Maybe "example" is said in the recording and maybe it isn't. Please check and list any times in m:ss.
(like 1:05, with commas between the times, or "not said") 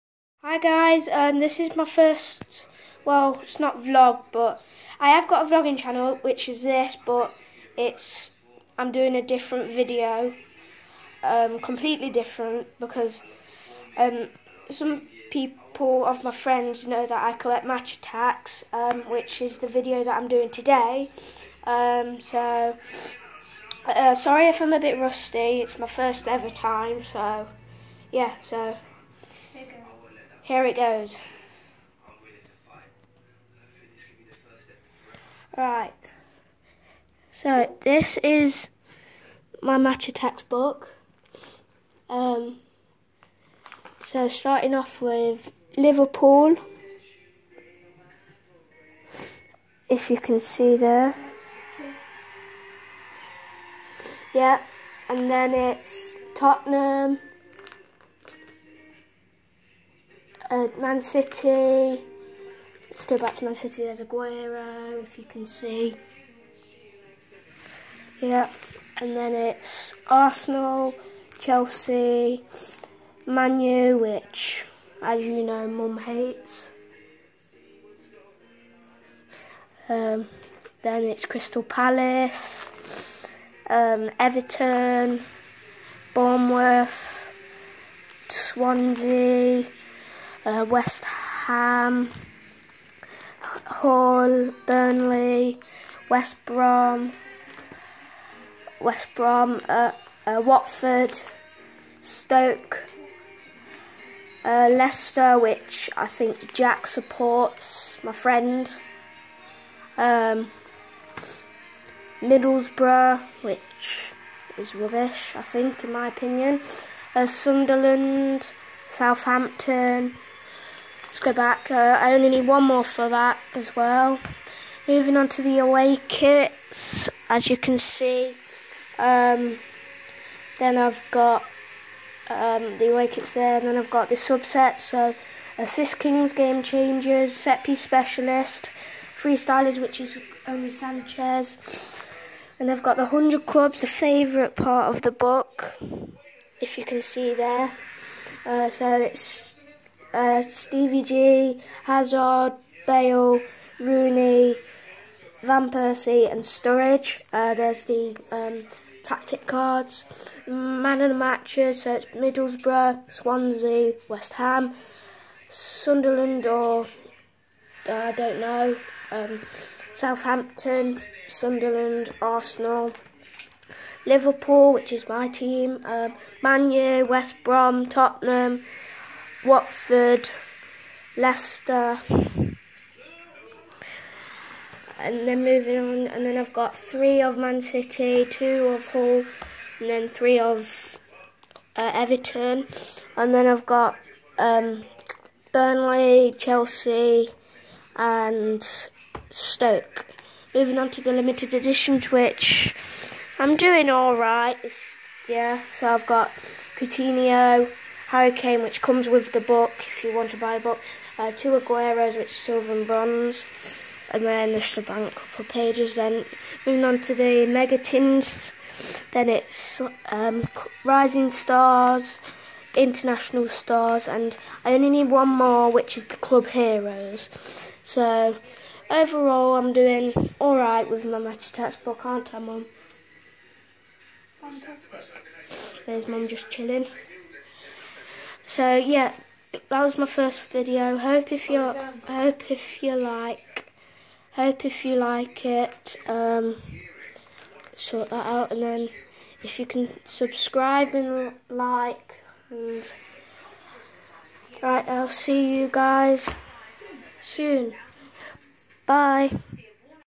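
not said.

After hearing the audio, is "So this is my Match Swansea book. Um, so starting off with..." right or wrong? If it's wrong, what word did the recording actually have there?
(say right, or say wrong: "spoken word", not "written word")
wrong: "Attax", not "Swansea".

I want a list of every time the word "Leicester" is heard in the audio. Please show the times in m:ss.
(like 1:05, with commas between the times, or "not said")
1:44, 3:01.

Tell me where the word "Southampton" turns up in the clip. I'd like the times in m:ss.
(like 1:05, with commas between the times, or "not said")
1:58, 2:49.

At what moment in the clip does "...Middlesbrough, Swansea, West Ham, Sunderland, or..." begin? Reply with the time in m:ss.
2:42.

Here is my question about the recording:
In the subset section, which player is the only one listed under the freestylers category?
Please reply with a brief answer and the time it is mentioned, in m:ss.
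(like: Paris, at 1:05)
Sanchez, at 2:20.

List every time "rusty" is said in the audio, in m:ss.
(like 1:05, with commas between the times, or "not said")
0:24.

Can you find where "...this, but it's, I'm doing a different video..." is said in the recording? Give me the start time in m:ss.
0:06.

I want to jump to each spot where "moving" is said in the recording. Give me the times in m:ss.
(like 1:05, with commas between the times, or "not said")
2:04, 3:05, 3:20, 3:36.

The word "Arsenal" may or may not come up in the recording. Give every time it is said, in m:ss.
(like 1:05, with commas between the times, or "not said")
1:10, 2:52.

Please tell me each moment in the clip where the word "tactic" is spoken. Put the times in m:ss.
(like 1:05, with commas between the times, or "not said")
2:39.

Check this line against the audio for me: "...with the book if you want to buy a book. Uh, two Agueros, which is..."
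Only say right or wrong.
right.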